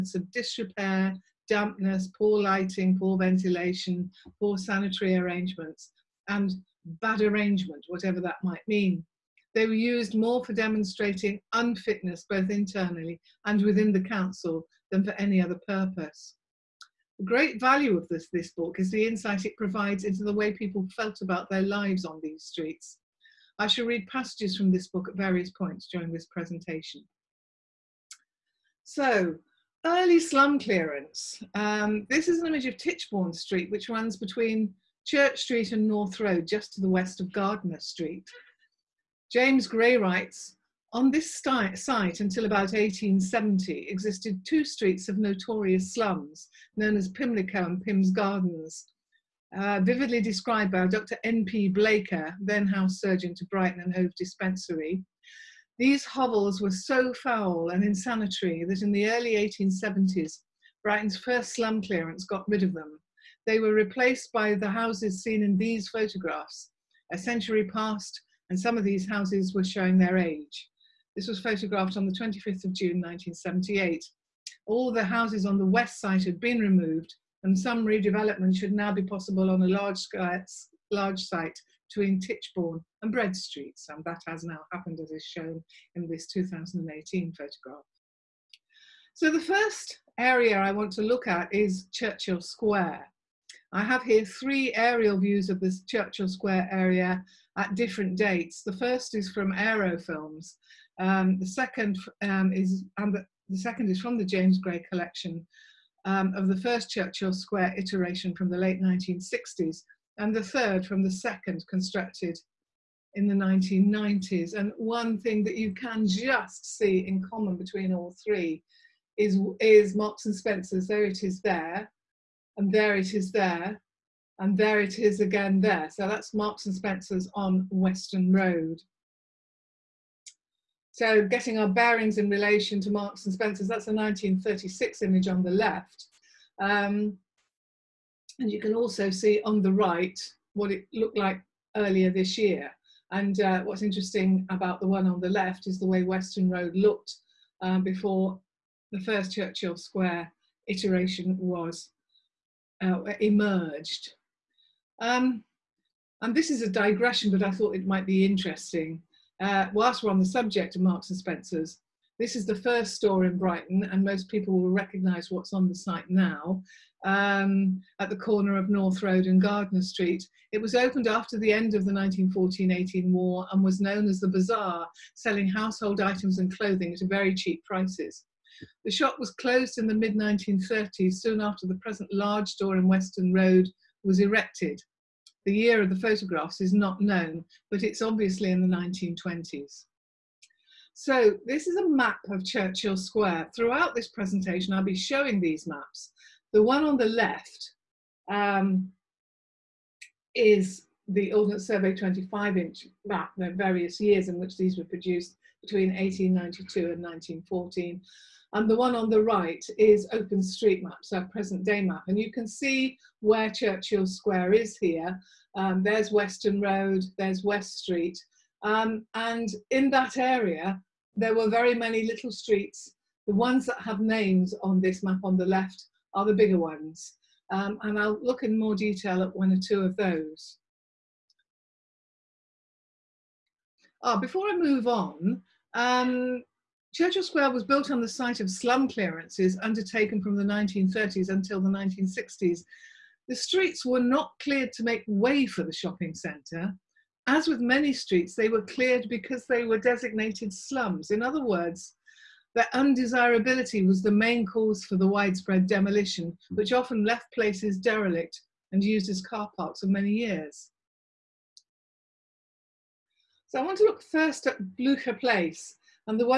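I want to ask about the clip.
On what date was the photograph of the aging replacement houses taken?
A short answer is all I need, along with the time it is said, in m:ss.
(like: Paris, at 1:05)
25 June 1978, at 1:12.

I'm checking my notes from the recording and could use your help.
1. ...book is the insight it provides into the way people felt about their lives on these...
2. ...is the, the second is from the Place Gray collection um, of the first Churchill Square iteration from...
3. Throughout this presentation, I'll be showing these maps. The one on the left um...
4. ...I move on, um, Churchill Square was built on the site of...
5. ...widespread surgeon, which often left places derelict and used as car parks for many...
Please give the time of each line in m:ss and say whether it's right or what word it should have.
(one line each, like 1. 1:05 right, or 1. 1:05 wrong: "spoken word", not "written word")
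1. 0:18 right
2. 1:42 wrong: "James", not "Place"
3. 3:13 right
4. 3:54 right
5. 4:15 wrong: "demolition", not "surgeon".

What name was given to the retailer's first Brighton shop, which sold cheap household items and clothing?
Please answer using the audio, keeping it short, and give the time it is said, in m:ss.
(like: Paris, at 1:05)
The Bazaar, at 2:54.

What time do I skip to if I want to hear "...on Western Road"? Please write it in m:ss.
2:07.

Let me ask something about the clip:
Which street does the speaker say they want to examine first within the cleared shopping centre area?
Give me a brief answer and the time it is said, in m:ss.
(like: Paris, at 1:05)
Blücher Place, at 4:24.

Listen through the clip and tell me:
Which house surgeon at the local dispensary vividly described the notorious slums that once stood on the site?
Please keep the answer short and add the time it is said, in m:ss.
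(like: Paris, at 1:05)
Dr. N.P. Blaker, at 0:50.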